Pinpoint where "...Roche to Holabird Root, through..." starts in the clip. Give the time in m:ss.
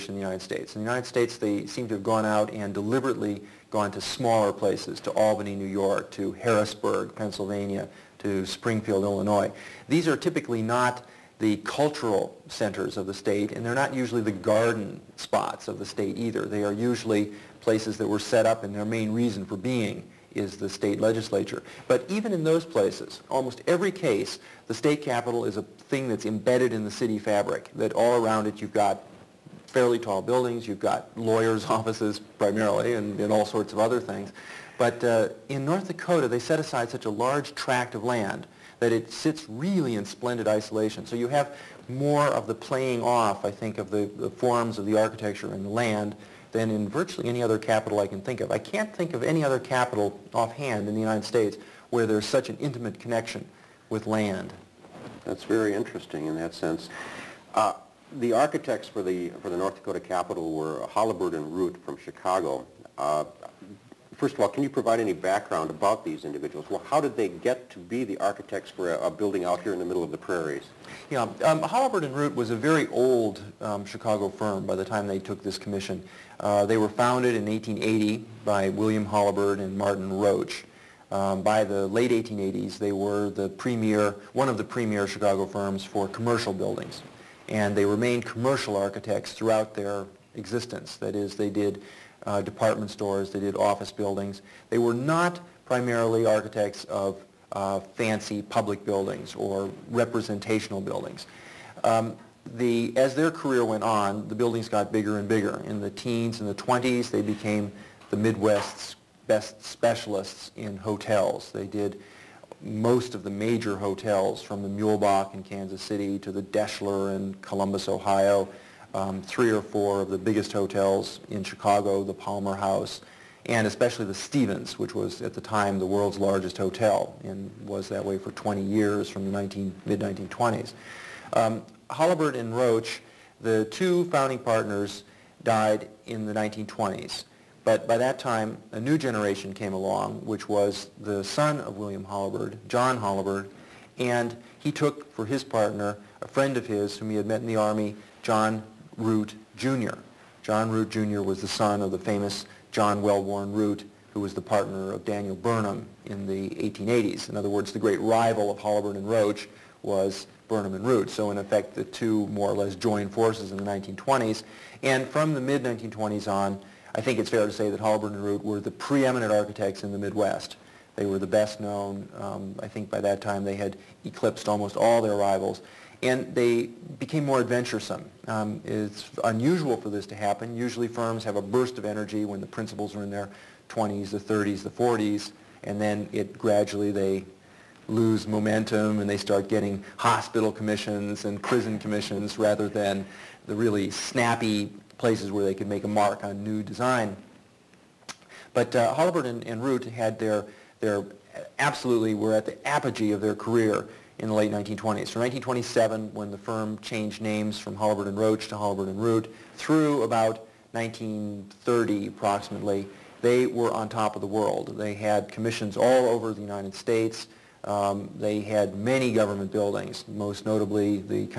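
3:28.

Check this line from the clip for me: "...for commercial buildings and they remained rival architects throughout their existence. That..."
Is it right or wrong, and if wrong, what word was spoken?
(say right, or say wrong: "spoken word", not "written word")
wrong: "commercial", not "rival".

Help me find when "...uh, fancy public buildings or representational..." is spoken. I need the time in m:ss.
1:37.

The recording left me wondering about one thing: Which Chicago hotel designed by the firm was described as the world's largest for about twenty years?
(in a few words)
The Stevens.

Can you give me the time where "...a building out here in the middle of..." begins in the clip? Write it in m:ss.
1:09.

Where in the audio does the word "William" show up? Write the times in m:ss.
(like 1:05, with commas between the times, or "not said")
1:18, 2:21.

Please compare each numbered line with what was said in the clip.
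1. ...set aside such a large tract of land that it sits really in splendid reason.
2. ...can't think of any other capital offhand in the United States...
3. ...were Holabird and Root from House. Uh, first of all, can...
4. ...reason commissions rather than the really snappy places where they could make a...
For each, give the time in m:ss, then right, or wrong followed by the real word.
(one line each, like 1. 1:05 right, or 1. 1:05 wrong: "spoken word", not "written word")
1. 0:36 wrong: "isolation", not "reason"
2. 0:48 right
3. 1:00 wrong: "Chicago", not "House"
4. 3:11 wrong: "prison", not "reason".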